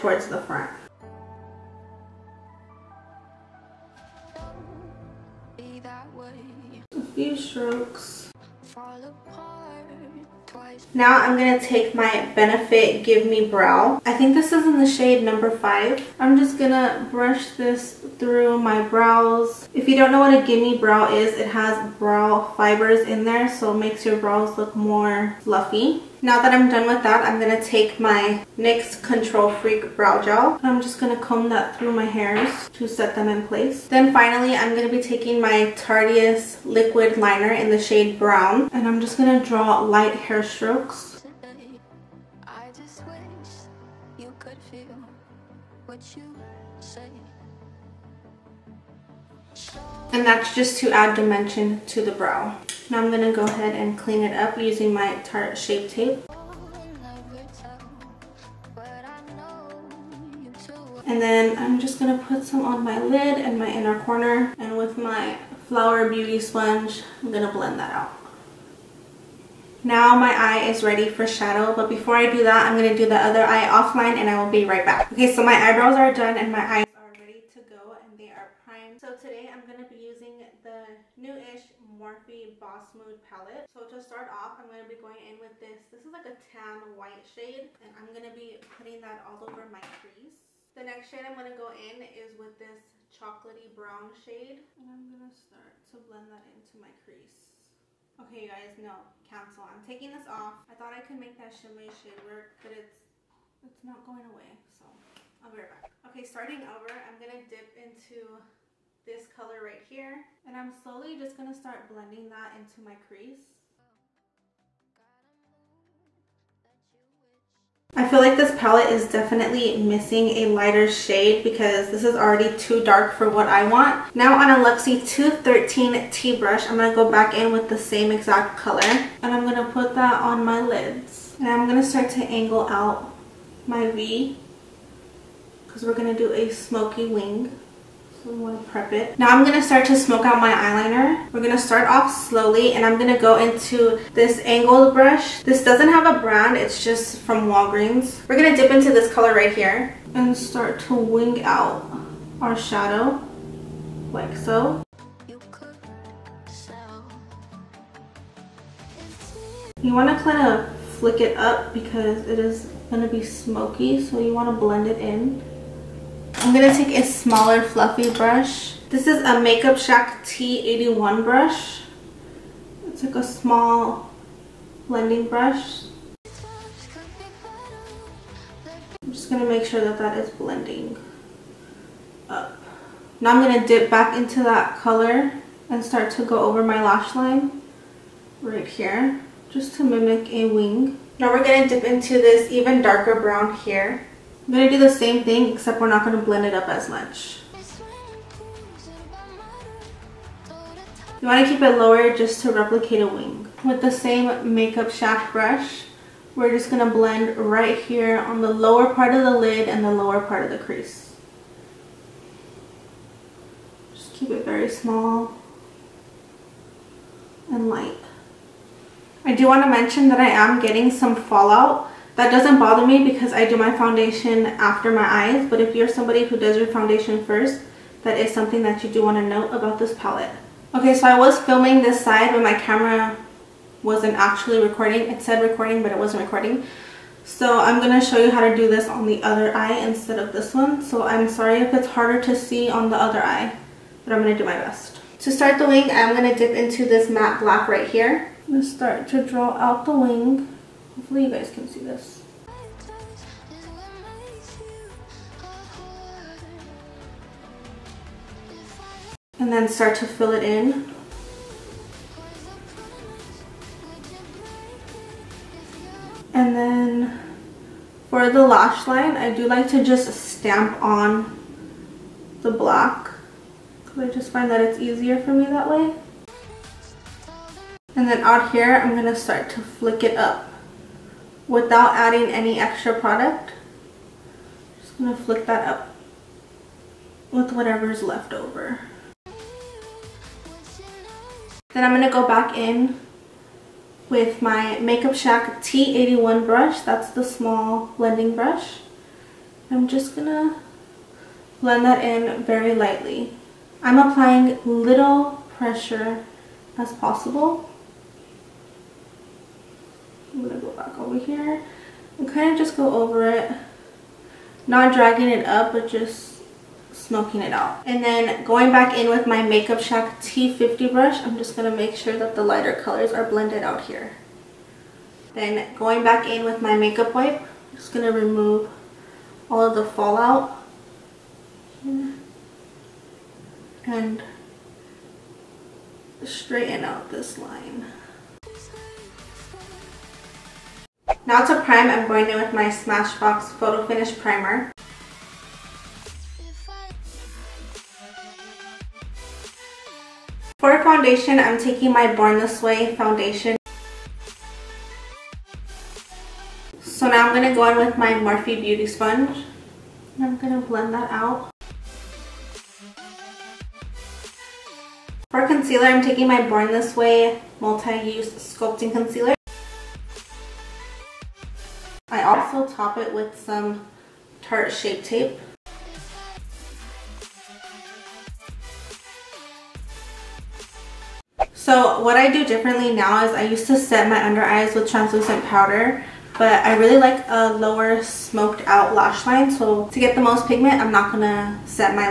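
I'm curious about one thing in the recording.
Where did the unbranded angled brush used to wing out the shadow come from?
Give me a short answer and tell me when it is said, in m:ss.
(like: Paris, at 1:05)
Walgreens, at 2:27.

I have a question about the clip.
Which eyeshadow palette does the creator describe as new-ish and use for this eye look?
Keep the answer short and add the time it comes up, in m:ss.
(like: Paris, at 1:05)
Morphe Boss Mood, at 1:21.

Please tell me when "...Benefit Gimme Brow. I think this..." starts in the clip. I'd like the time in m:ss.
0:12.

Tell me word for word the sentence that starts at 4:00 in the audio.
So I'm sorry if it's harder to see on the other eye, but I'm going to do my best.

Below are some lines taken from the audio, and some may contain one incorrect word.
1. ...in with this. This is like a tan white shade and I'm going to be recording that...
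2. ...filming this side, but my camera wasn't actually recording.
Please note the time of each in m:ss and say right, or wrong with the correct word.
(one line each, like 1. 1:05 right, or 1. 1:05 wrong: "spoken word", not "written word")
1. 1:25 wrong: "putting", not "recording"
2. 3:51 right.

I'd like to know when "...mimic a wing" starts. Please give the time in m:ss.
3:09.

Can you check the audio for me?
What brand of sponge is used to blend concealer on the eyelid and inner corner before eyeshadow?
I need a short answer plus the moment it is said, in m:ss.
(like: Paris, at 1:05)
Flower Beauty, at 1:05.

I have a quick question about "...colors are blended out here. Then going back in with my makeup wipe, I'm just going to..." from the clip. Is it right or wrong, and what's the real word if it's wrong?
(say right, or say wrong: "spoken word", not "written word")
right.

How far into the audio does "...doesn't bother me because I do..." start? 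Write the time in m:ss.
3:42.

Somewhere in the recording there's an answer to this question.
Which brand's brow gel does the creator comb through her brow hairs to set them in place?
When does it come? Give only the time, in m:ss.
0:28.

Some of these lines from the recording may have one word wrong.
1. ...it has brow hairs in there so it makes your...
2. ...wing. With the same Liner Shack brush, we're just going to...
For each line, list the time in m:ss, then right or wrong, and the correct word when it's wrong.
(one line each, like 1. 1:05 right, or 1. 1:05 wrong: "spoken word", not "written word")
1. 0:21 wrong: "fibers", not "hairs"
2. 3:23 wrong: "Makeup", not "Liner".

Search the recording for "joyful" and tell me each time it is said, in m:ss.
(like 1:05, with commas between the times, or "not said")
not said.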